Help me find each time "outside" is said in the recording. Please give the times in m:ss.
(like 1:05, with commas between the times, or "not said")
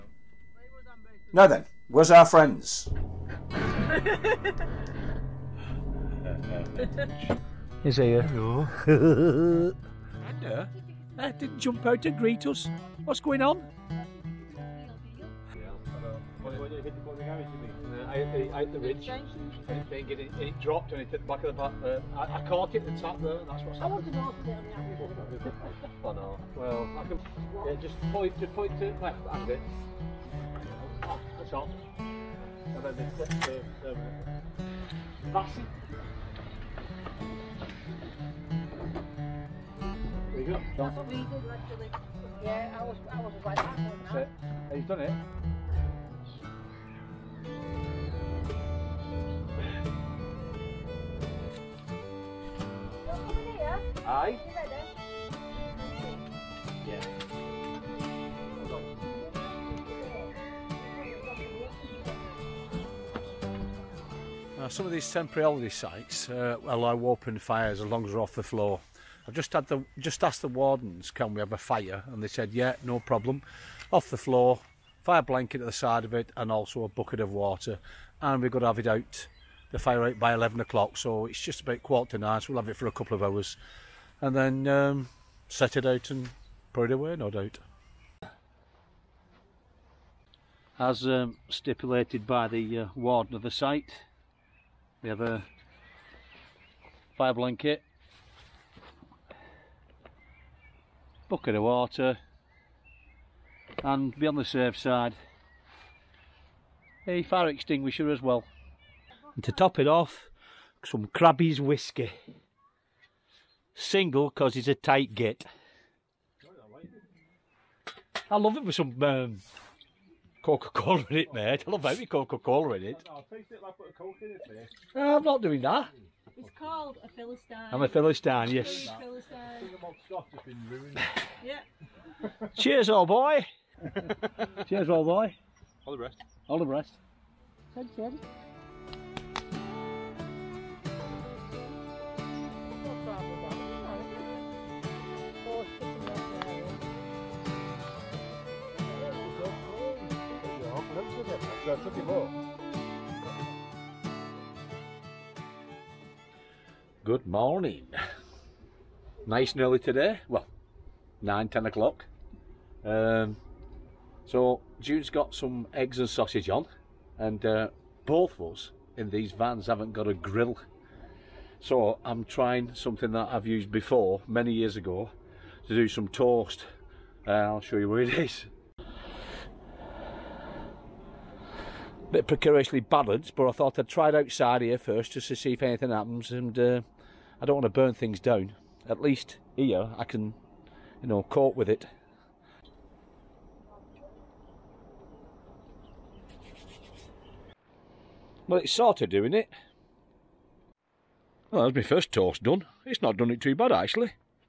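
3:04.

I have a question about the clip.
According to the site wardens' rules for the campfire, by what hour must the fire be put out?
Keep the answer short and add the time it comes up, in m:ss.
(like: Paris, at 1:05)
11 o'clock, at 1:20.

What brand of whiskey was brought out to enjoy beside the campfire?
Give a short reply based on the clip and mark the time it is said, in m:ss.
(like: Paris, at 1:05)
Crabbie's, at 1:51.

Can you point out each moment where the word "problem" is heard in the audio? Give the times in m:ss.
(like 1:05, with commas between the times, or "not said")
1:12.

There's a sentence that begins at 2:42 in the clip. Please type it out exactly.
Um, so Jude's got some eggs and sausage on, and uh, both of us in these vans haven't got a grill.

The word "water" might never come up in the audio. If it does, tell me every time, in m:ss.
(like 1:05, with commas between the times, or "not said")
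1:17, 1:41.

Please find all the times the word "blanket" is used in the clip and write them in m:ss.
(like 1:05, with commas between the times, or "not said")
1:15, 1:37.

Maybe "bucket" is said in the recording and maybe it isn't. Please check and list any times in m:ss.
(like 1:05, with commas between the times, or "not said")
1:16, 1:41.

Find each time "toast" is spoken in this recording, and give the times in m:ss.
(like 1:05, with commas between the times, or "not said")
2:56, 3:22.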